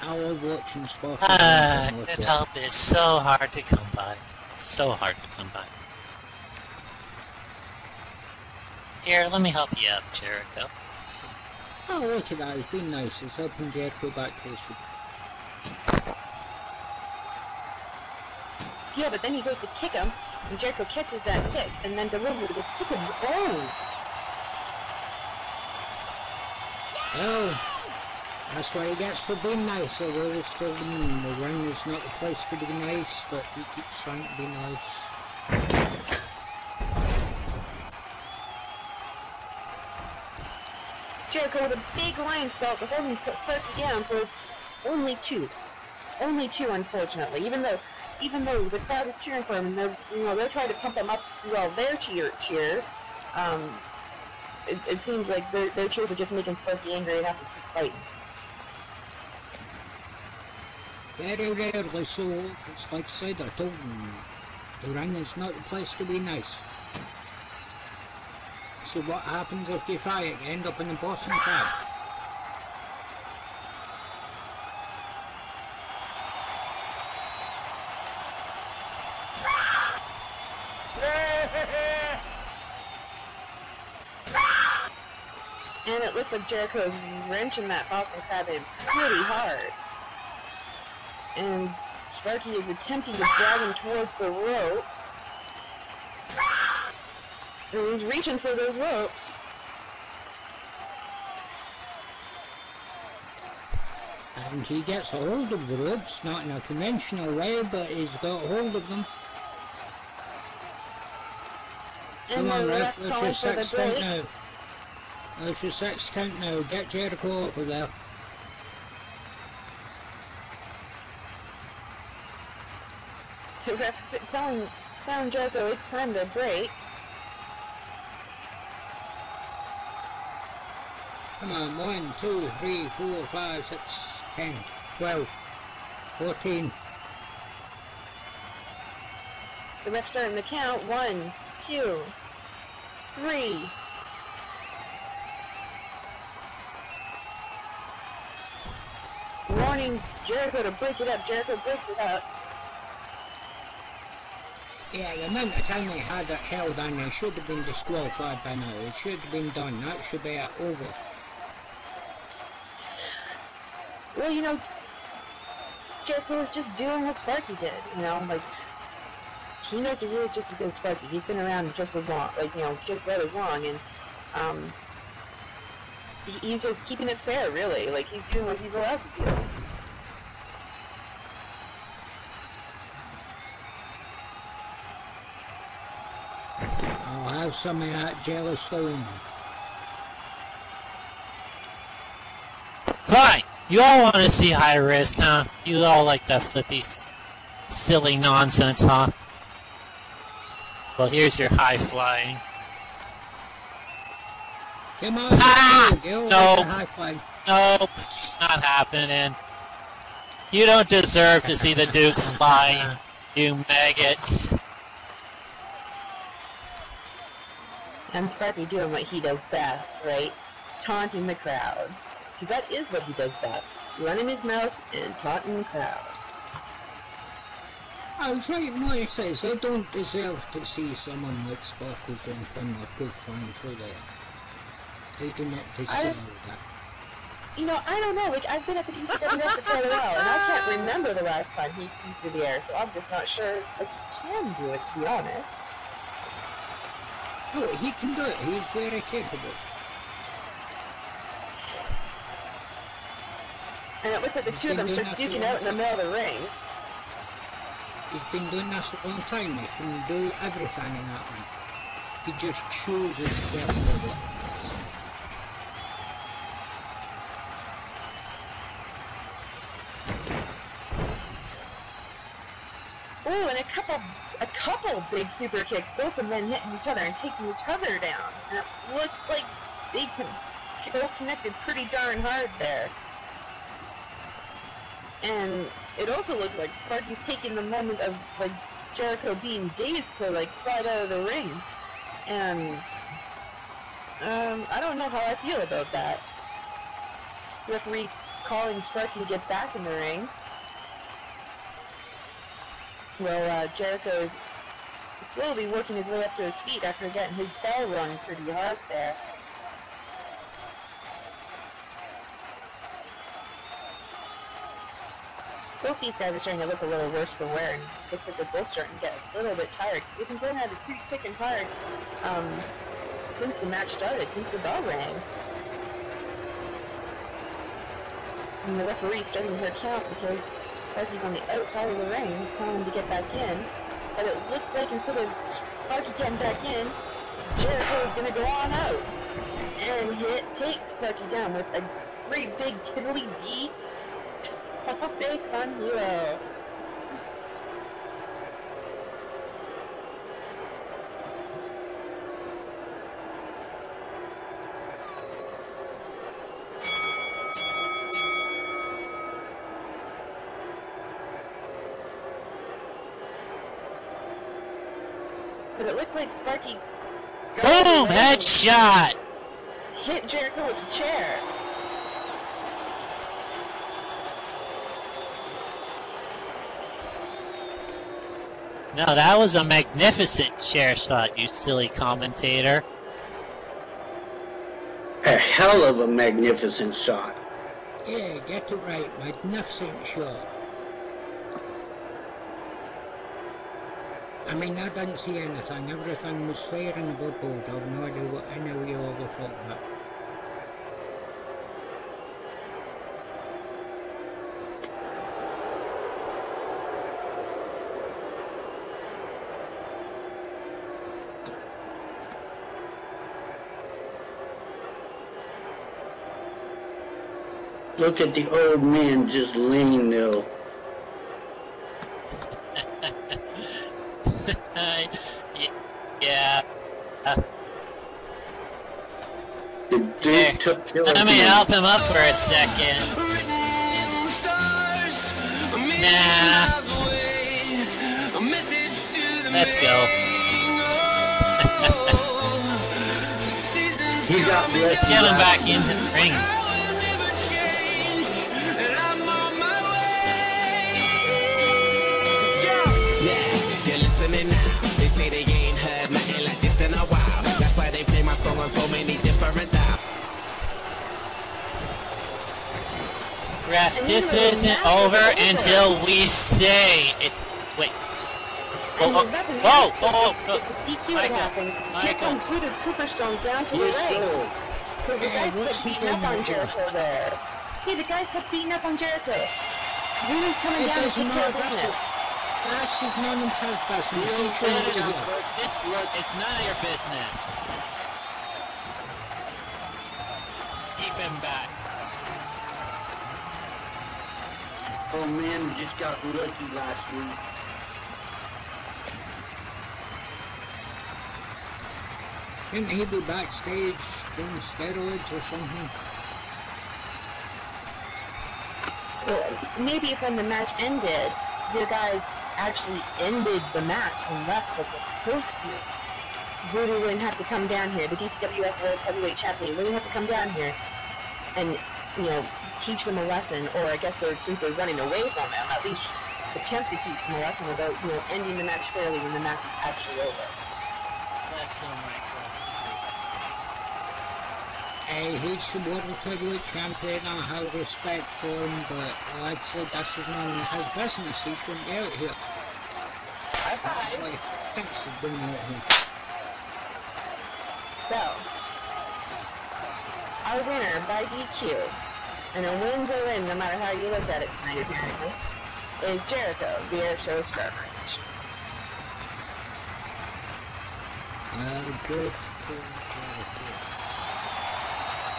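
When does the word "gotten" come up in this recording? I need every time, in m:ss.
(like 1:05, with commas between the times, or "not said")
not said.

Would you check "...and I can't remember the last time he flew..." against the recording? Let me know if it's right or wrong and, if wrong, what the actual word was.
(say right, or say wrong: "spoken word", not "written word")
right.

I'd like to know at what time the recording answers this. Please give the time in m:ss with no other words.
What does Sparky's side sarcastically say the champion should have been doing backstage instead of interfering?
8:24.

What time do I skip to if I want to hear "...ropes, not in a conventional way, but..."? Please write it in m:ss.
1:45.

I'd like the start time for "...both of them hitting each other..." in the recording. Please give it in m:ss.
4:35.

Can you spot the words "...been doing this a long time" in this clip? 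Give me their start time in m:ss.
4:18.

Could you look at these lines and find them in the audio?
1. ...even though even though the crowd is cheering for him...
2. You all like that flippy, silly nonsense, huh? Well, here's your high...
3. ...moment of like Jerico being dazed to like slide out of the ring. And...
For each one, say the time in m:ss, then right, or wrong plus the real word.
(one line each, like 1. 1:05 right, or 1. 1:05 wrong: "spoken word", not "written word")
1. 0:47 right
2. 3:15 right
3. 4:47 right.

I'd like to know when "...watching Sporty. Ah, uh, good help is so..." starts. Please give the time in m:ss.
0:00.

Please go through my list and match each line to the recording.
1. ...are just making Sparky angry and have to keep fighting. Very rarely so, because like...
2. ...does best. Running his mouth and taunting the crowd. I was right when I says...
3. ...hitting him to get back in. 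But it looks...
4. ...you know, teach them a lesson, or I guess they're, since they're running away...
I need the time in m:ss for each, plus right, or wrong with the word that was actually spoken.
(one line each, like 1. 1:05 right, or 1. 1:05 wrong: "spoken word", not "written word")
1. 0:56 right
2. 3:43 right
3. 5:32 wrong: "telling", not "hitting"
4. 8:42 right.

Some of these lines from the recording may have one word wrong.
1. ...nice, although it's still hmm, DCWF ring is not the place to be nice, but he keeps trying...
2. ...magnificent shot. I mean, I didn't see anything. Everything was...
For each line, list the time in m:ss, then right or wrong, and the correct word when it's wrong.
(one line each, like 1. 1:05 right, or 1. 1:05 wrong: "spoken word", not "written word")
1. 0:29 wrong: "The", not "DCWF"
2. 6:29 right.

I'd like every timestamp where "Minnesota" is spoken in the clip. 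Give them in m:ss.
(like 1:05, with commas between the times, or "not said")
not said.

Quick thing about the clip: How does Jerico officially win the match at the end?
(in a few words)
by DQ.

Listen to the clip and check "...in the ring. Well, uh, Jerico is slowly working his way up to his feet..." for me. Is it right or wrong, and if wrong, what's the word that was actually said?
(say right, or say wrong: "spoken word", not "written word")
right.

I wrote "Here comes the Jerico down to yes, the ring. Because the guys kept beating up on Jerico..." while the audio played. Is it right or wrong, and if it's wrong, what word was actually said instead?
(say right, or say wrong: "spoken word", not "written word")
wrong: "Superstone", not "Jerico".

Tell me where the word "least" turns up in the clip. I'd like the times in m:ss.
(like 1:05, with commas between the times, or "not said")
8:45.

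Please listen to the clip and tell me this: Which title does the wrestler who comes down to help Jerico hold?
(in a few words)
DCWF World Heavyweight Champion.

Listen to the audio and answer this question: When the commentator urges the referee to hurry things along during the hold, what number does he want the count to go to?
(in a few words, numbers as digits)
6.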